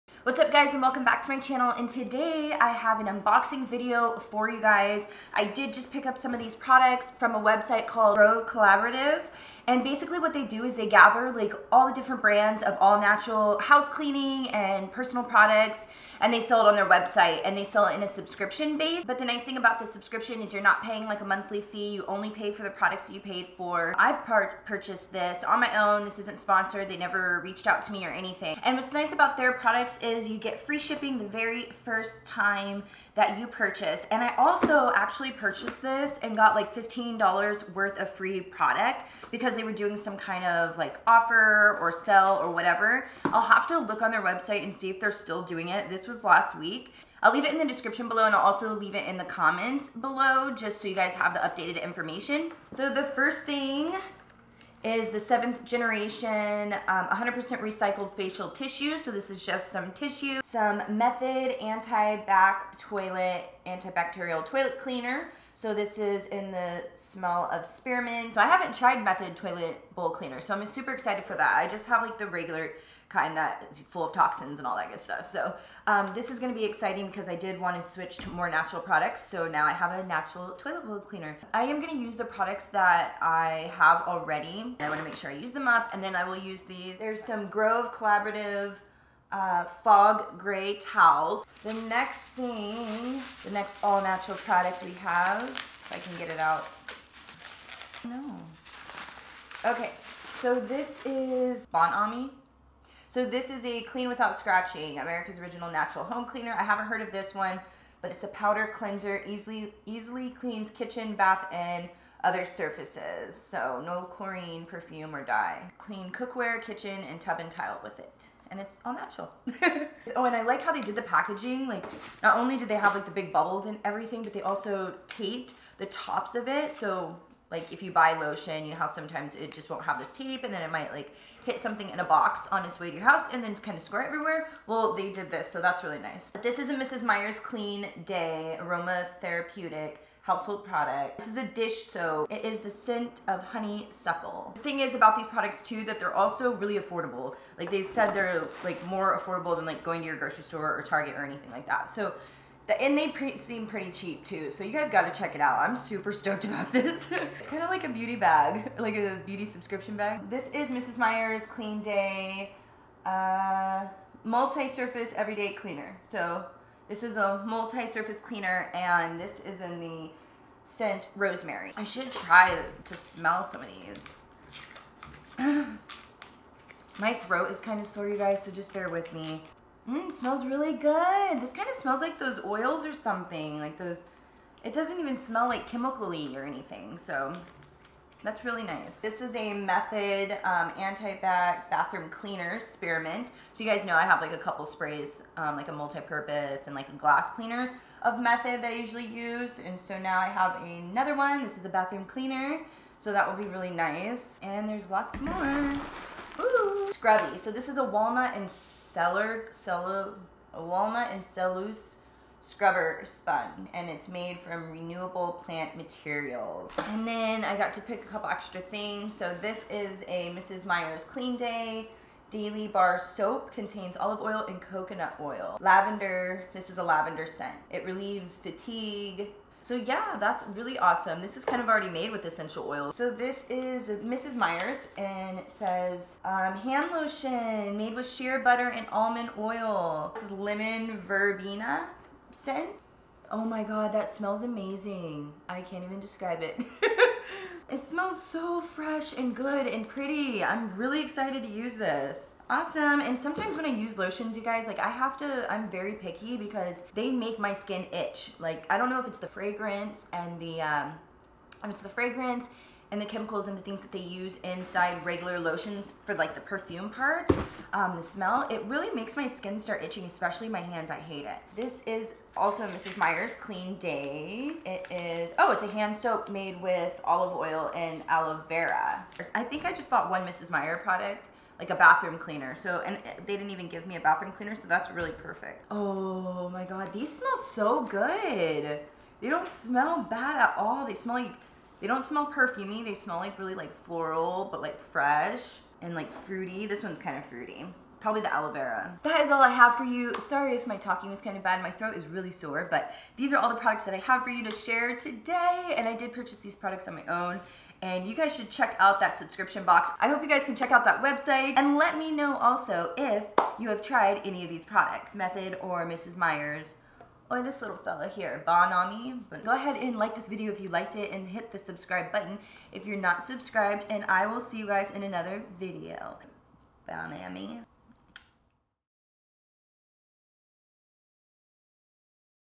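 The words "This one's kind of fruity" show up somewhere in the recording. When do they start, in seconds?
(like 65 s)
296 s.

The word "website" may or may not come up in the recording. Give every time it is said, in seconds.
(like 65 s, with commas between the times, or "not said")
7 s, 16 s, 44 s, 311 s.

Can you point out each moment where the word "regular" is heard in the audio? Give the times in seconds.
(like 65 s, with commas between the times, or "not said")
72 s, 265 s.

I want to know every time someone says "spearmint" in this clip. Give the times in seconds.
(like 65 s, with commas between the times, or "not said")
67 s, 192 s.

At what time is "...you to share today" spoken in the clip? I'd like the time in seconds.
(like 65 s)
304 s.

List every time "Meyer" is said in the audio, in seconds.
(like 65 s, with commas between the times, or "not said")
137 s, 160 s, 220 s, 234 s, 272 s, 280 s, 316 s.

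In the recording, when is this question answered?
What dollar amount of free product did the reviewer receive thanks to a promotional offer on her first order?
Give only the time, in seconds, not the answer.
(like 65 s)
36 s.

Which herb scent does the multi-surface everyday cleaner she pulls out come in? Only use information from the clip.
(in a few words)
Rosemary.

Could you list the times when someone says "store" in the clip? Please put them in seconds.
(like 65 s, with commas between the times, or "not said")
150 s.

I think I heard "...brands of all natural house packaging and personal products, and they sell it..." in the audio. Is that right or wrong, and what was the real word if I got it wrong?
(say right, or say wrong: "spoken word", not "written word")
wrong: "cleaning", not "packaging".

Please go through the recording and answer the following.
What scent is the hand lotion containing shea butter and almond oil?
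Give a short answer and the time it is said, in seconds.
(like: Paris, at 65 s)
Lemon verbena, at 240 s.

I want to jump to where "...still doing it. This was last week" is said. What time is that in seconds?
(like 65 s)
45 s.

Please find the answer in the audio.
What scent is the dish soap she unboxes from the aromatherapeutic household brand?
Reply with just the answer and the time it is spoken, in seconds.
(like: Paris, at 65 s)
Honeysuckle, at 143 s.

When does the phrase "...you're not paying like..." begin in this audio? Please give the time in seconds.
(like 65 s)
20 s.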